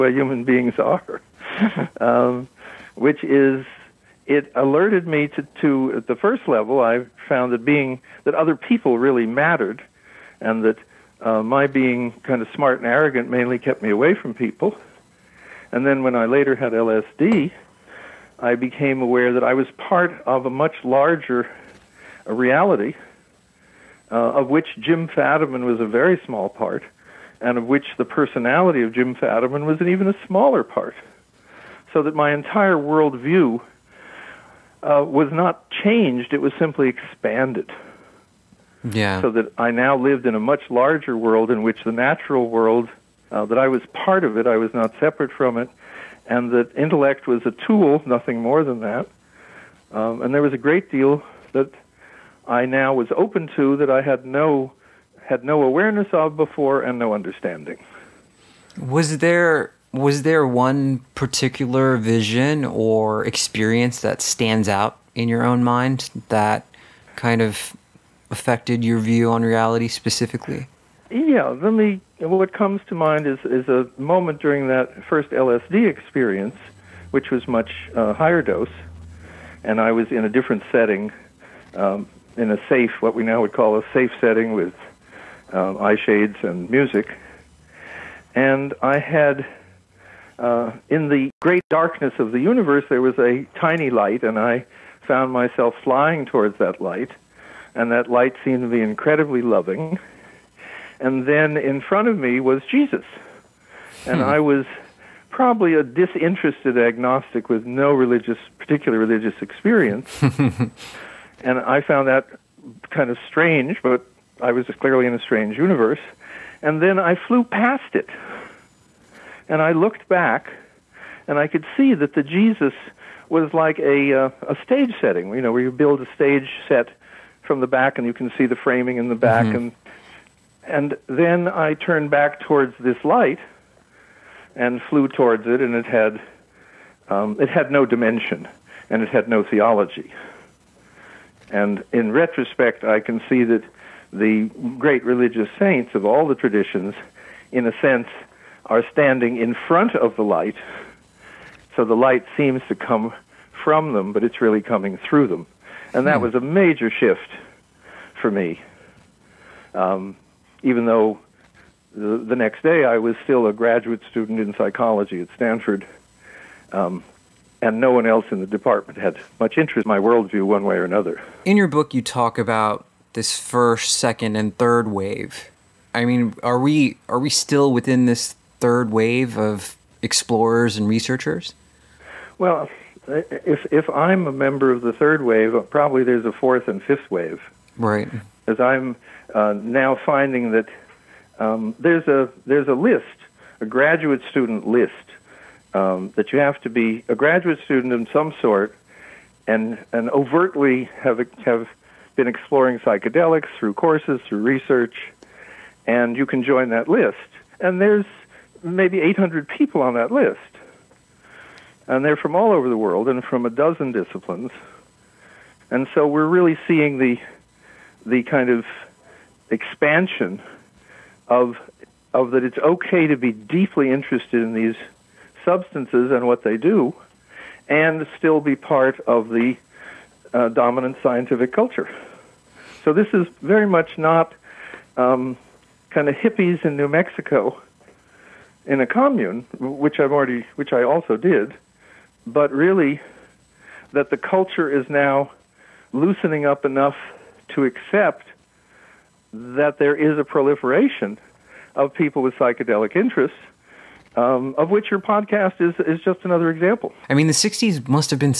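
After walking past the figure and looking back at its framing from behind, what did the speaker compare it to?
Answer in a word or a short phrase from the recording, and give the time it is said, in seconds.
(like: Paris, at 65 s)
A stage setting, at 124 s.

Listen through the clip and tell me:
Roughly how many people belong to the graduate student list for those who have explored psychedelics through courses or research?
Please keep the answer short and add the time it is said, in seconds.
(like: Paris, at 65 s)
800, at 209 s.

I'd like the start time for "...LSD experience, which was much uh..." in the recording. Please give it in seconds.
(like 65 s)
75 s.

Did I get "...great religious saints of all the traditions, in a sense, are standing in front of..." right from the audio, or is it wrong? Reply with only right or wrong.
right.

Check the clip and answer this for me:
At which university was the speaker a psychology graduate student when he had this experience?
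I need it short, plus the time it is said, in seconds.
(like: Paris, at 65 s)
Stanford, at 165 s.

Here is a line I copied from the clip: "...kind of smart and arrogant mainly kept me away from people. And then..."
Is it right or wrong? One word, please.
right.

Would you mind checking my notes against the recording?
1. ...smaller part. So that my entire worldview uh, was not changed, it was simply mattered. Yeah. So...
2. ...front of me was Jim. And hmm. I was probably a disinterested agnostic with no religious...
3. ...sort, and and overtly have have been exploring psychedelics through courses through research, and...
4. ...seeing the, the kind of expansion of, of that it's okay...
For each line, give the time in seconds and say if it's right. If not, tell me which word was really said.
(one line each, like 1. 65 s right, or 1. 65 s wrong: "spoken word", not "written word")
1. 30 s wrong: "expanded", not "mattered"
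2. 101 s wrong: "Jesus", not "Jim"
3. 198 s right
4. 216 s right.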